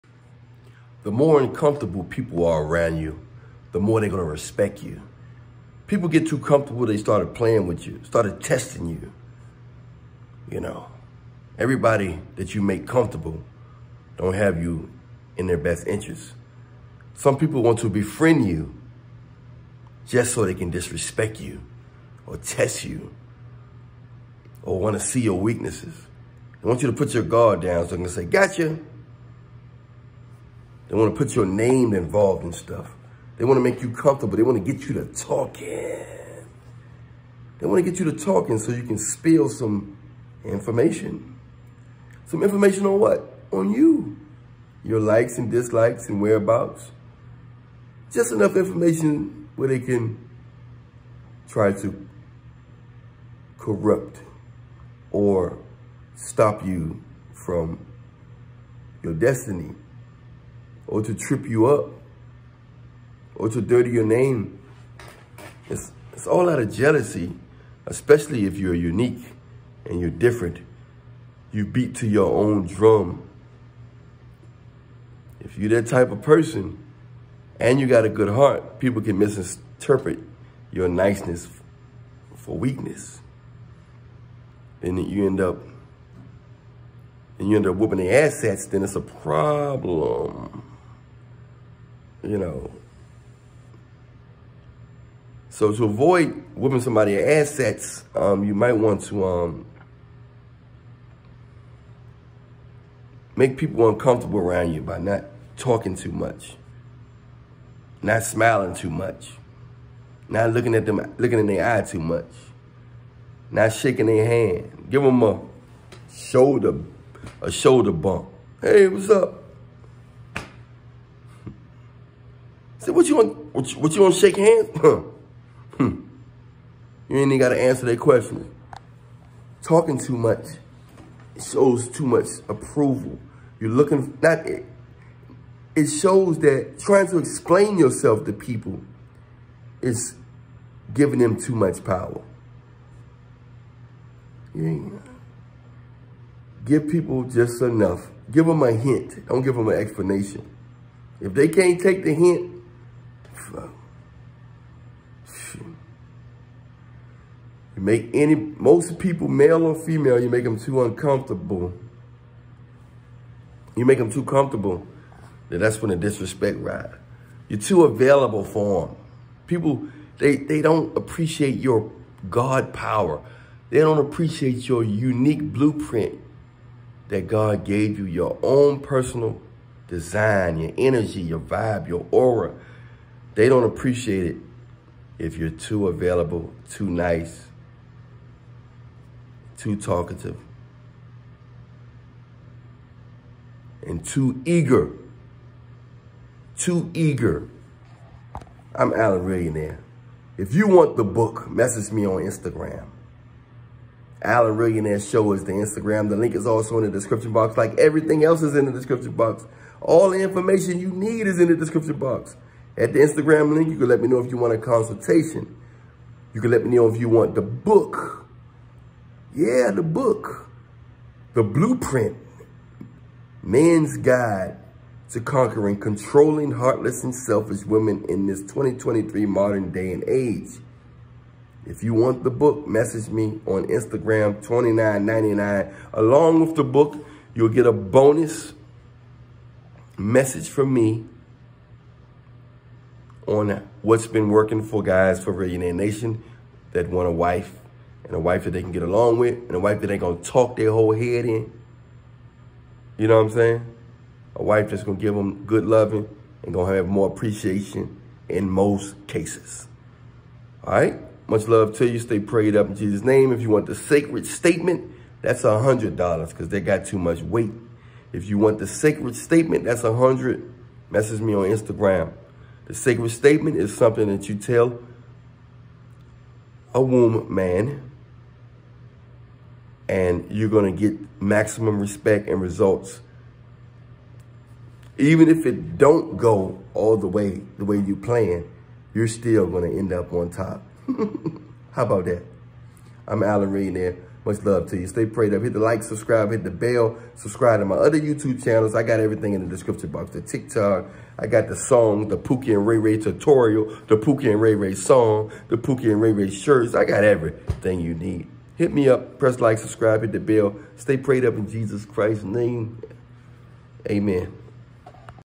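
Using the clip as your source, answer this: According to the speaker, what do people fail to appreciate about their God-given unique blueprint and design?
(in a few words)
God power.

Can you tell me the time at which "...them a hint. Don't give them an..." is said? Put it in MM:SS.
02:28.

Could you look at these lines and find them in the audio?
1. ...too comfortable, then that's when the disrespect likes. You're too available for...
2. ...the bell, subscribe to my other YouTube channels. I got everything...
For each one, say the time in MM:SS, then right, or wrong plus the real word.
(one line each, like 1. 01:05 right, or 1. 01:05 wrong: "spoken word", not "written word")
1. 02:44 wrong: "rides", not "likes"
2. 04:56 right.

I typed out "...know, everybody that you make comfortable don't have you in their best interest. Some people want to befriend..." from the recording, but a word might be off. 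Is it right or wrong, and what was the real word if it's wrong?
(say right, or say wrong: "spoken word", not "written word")
right.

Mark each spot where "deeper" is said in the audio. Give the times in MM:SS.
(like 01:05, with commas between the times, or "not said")
not said.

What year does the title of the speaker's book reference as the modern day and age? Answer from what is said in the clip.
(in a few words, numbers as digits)
2023.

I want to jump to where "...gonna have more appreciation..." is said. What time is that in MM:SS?
04:16.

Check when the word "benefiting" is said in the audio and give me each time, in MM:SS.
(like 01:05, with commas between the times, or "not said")
not said.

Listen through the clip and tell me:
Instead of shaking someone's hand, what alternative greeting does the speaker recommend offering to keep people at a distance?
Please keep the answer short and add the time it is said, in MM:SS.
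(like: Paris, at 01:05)
shoulder bump, at 01:57.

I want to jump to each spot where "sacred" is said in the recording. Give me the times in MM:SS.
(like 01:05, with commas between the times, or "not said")
04:23, 04:28, 04:32.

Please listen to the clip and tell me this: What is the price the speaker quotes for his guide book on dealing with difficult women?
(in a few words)
$29.99.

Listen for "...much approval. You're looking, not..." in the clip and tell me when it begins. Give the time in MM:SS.
02:12.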